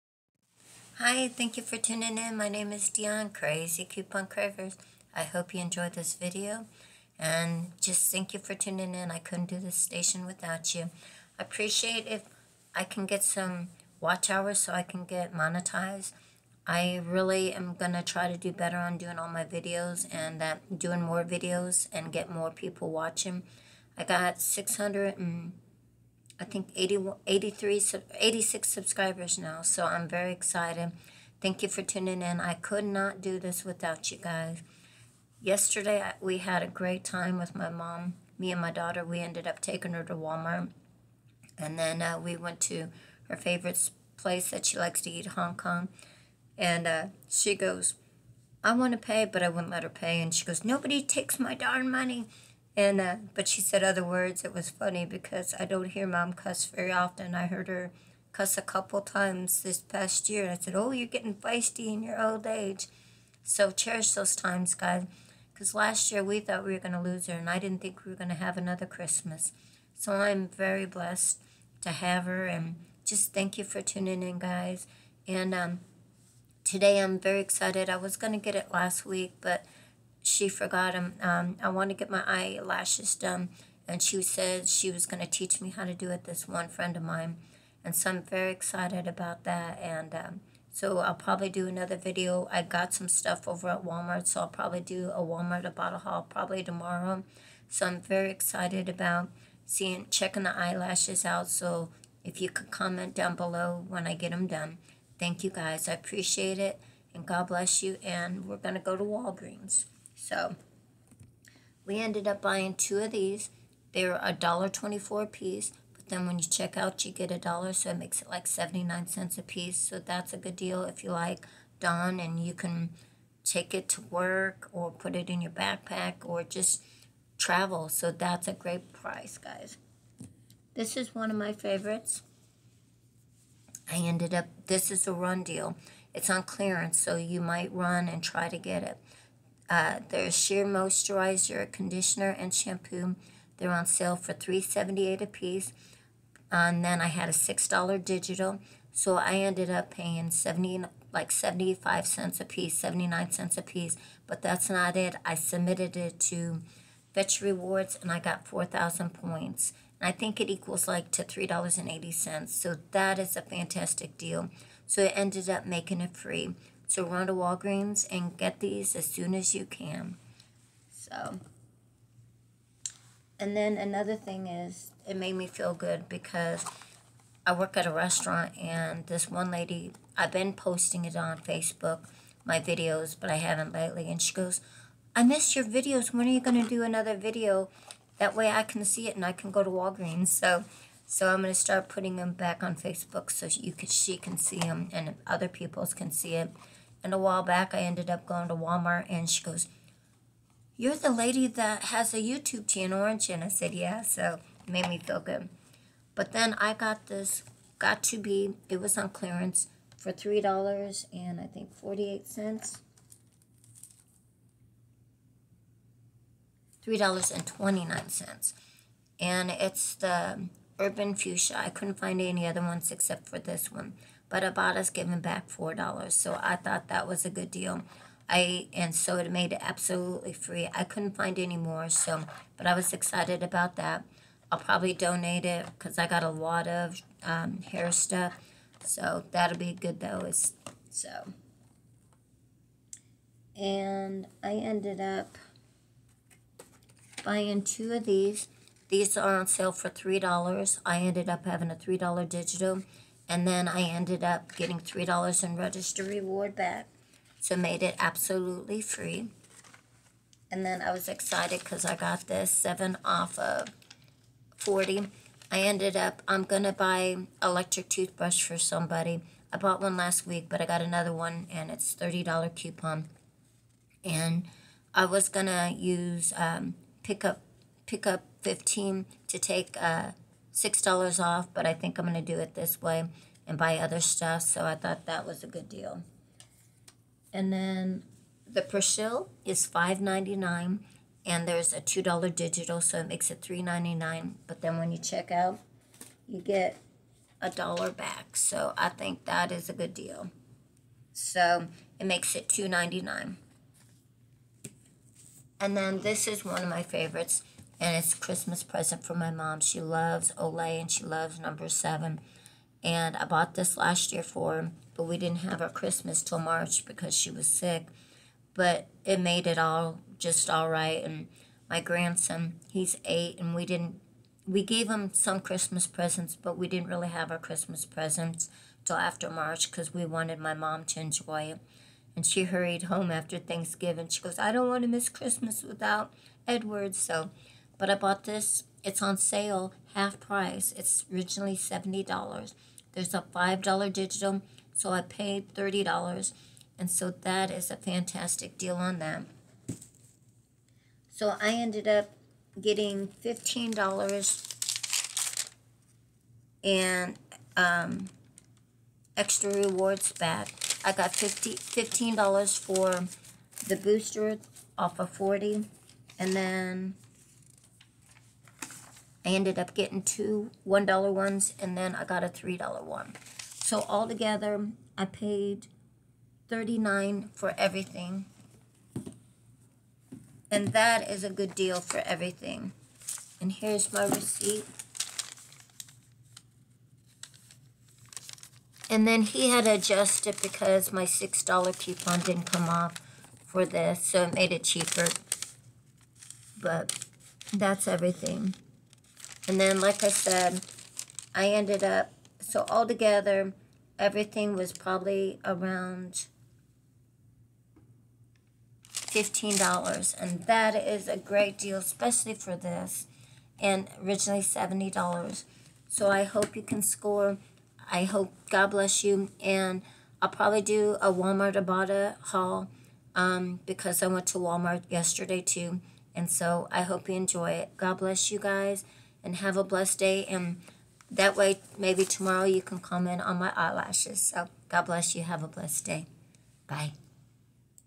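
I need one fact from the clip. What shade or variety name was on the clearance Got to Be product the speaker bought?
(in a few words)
Urban Fuchsia.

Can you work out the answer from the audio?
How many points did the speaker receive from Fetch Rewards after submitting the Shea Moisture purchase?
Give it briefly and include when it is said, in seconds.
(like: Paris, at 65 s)
4,000, at 158 s.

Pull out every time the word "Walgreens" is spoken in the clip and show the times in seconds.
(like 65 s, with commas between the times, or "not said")
109 s, 167 s, 189 s.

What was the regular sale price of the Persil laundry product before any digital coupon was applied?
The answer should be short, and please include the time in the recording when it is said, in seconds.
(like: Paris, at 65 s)
$5.99, at 289 s.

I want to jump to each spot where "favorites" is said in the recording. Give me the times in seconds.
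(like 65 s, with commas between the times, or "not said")
43 s, 131 s, 306 s.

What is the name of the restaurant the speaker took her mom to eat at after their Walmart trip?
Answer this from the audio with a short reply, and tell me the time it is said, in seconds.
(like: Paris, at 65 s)
Hong Kong, at 45 s.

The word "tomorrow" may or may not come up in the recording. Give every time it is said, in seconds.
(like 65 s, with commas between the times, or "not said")
96 s, 432 s.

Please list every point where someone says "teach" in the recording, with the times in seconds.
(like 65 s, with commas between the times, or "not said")
85 s.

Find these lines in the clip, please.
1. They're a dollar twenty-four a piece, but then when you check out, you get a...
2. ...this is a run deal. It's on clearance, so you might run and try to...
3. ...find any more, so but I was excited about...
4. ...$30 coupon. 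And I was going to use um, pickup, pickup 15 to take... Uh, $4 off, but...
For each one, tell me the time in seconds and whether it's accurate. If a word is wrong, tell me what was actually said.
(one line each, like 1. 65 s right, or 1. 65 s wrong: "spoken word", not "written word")
1. 113 s right
2. 134 s right
3. 231 s right
4. 271 s wrong: "6", not "4".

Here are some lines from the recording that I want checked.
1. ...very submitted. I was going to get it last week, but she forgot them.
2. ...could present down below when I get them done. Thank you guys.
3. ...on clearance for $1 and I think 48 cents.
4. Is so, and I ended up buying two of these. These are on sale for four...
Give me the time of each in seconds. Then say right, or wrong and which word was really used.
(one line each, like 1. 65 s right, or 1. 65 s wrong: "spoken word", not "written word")
1. 77 s wrong: "excited", not "submitted"
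2. 102 s wrong: "comment", not "present"
3. 208 s wrong: "3", not "1"
4. 240 s wrong: "three", not "four".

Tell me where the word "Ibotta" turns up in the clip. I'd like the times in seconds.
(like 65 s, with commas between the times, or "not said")
95 s, 421 s.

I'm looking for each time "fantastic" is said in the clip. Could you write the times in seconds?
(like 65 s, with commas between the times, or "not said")
163 s, 347 s.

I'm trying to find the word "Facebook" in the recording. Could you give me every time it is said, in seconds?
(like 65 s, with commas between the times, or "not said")
181 s, 192 s.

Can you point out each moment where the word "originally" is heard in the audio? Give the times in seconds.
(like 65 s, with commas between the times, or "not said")
341 s, 414 s.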